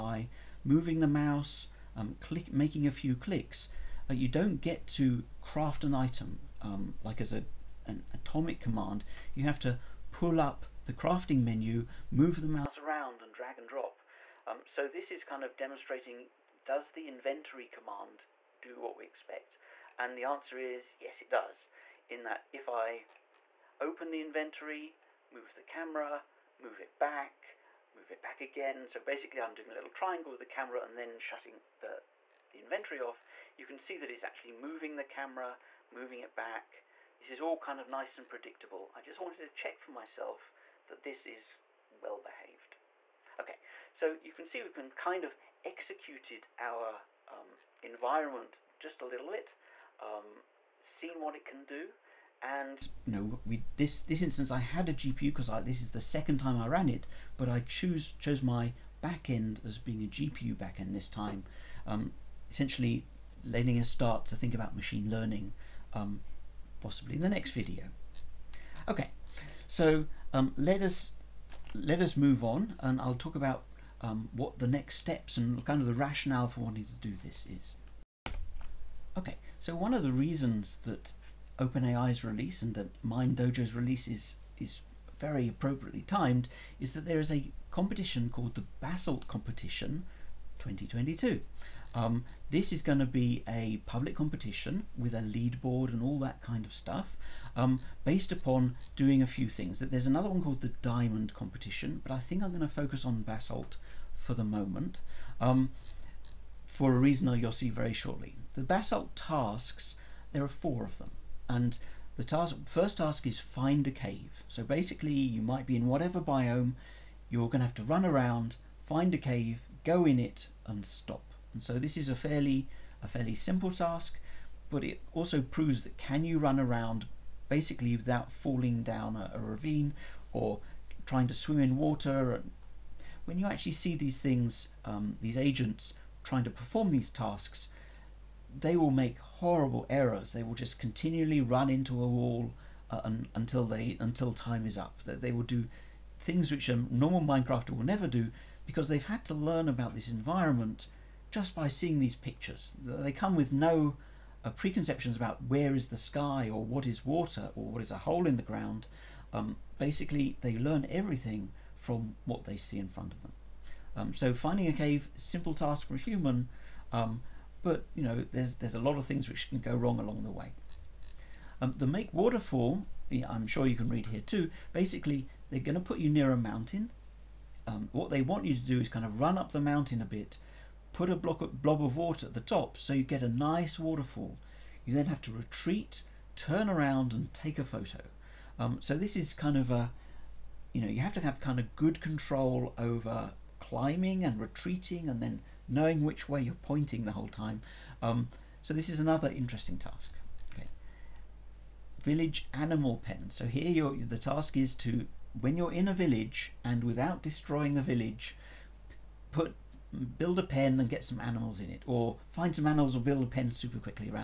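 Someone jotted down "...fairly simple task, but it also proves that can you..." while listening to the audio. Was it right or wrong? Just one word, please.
right.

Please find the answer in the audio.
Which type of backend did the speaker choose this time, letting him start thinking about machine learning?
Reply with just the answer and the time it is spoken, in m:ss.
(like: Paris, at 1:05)
GPU backend, at 1:00.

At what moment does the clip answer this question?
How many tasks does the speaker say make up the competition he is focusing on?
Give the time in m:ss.
1:50.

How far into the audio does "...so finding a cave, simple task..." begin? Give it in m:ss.
2:44.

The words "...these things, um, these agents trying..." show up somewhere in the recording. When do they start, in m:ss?
2:13.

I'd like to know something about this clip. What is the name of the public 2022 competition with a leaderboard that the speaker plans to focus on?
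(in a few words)
Basalt Competition.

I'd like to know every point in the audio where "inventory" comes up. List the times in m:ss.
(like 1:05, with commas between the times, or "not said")
0:17, 0:24, 0:32.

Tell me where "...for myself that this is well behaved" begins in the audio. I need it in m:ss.
0:39.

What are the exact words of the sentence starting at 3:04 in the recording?
You then have to retreat, turn around and take a photo.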